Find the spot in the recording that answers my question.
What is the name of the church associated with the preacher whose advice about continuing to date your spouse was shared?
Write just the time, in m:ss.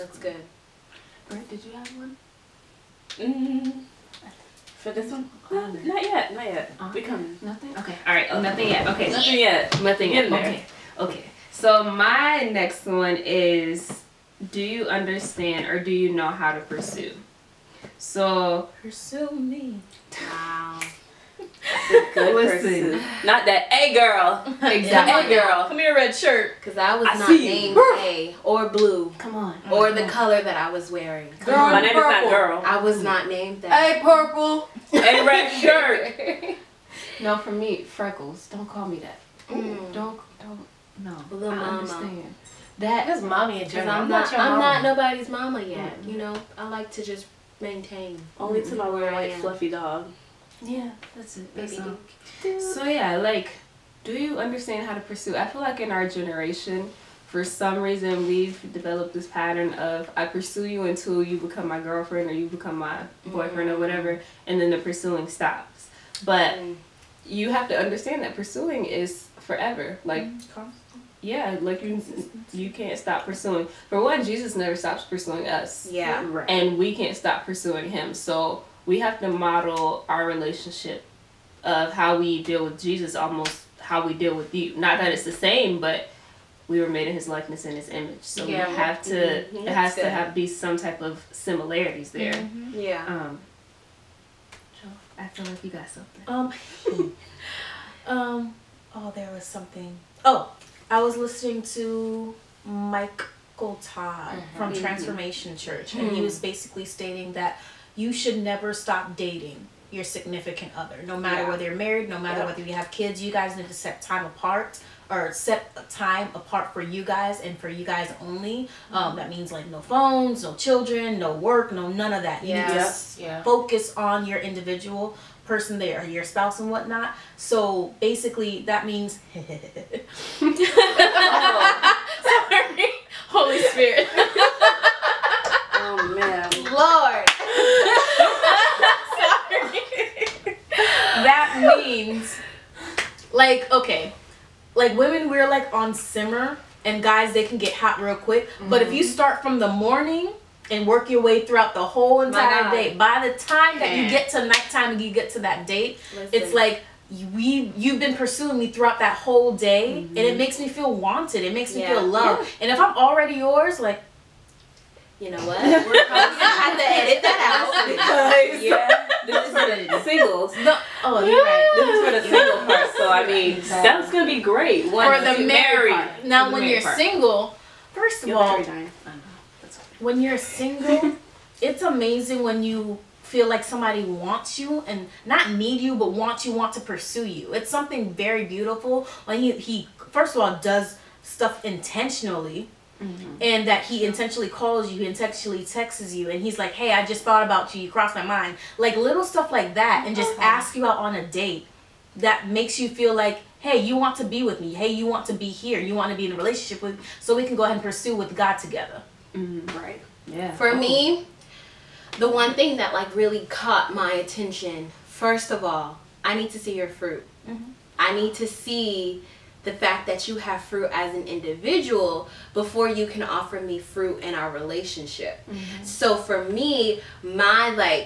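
1:44.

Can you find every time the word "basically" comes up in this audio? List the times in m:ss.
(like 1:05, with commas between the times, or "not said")
1:46, 2:08.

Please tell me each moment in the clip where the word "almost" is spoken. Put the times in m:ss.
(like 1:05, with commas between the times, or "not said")
1:23.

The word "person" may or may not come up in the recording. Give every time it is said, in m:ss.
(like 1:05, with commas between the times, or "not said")
0:22, 2:05.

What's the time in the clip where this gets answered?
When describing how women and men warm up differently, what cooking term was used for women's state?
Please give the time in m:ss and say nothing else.
2:25.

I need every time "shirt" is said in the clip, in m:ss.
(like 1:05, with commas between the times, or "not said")
0:26, 0:35.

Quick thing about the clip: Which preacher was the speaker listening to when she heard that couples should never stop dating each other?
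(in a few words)
Michael Todd.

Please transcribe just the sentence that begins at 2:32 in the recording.
By the time that you get to nighttime and you get to that date, Listen.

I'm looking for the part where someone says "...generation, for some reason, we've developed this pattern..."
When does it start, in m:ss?
0:56.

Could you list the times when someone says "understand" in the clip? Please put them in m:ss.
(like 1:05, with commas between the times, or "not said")
0:14, 0:41, 0:54, 1:07.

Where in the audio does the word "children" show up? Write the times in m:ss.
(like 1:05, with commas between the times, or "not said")
2:00.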